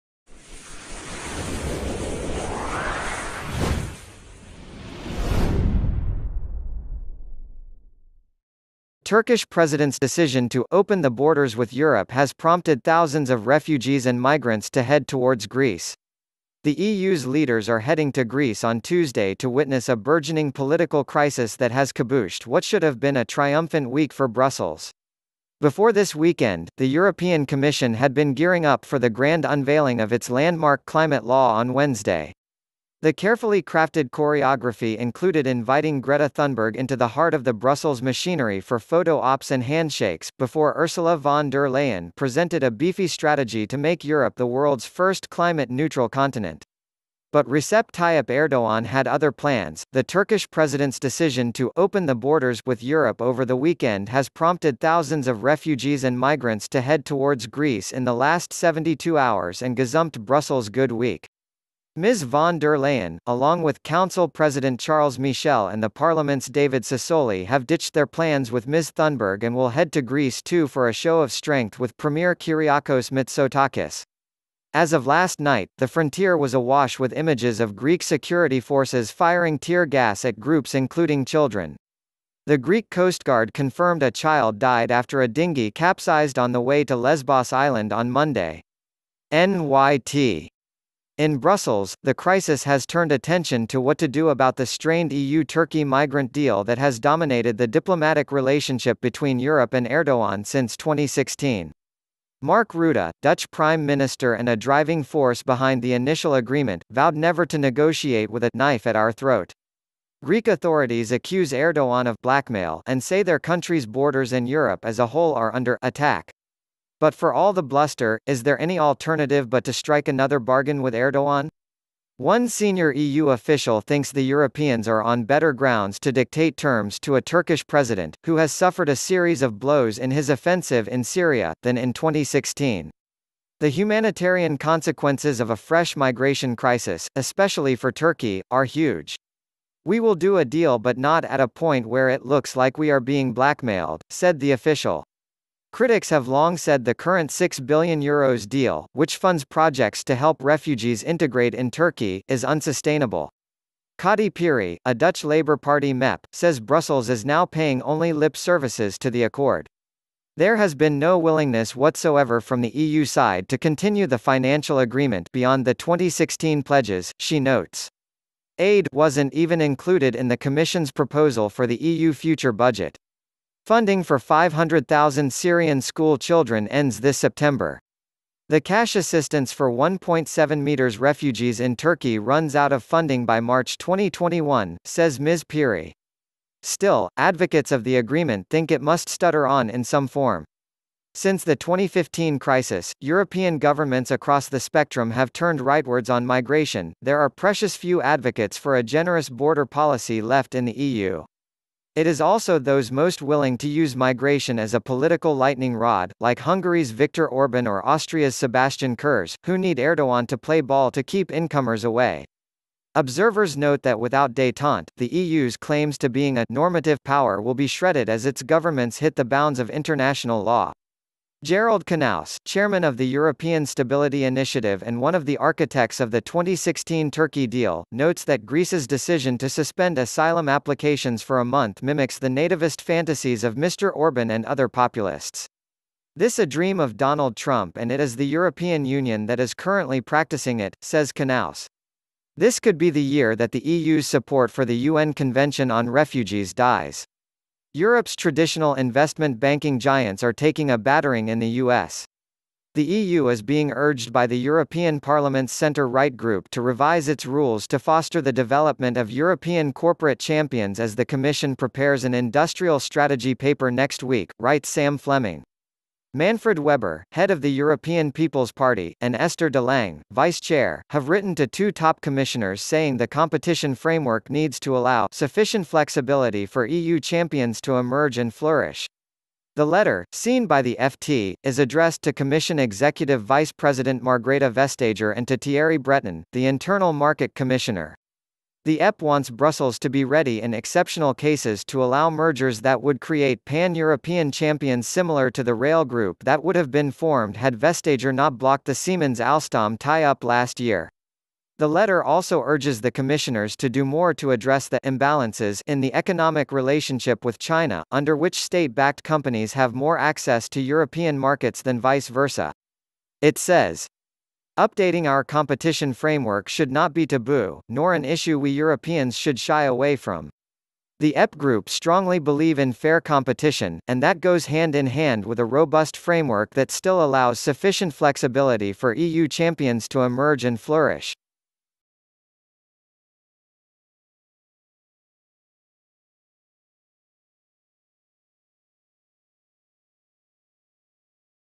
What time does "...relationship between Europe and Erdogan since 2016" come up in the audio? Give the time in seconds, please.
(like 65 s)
98 s.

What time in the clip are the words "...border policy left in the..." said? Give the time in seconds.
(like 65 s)
199 s.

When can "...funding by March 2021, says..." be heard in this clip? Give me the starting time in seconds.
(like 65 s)
182 s.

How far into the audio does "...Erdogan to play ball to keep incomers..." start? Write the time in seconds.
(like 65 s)
209 s.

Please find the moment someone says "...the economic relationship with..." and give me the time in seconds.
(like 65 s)
305 s.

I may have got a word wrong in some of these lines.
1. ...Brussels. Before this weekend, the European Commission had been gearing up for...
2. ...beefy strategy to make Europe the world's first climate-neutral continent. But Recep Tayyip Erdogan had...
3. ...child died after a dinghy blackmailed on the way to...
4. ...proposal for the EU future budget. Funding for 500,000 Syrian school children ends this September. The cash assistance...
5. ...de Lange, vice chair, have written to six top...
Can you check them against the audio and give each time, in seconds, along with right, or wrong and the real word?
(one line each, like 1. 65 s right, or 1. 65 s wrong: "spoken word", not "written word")
1. 24 s right
2. 42 s right
3. 84 s wrong: "capsized", not "blackmailed"
4. 170 s right
5. 269 s wrong: "two", not "six".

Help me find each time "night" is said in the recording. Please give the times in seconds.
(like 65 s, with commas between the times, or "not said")
75 s.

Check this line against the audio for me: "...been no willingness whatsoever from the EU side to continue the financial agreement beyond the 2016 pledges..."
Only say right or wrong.
right.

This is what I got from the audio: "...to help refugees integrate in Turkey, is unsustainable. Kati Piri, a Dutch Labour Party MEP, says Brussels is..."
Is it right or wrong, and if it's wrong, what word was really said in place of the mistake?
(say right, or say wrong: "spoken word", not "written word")
right.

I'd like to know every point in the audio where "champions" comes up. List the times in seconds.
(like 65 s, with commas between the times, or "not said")
260 s, 276 s, 294 s, 329 s.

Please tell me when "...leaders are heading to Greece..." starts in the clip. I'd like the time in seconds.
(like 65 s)
17 s.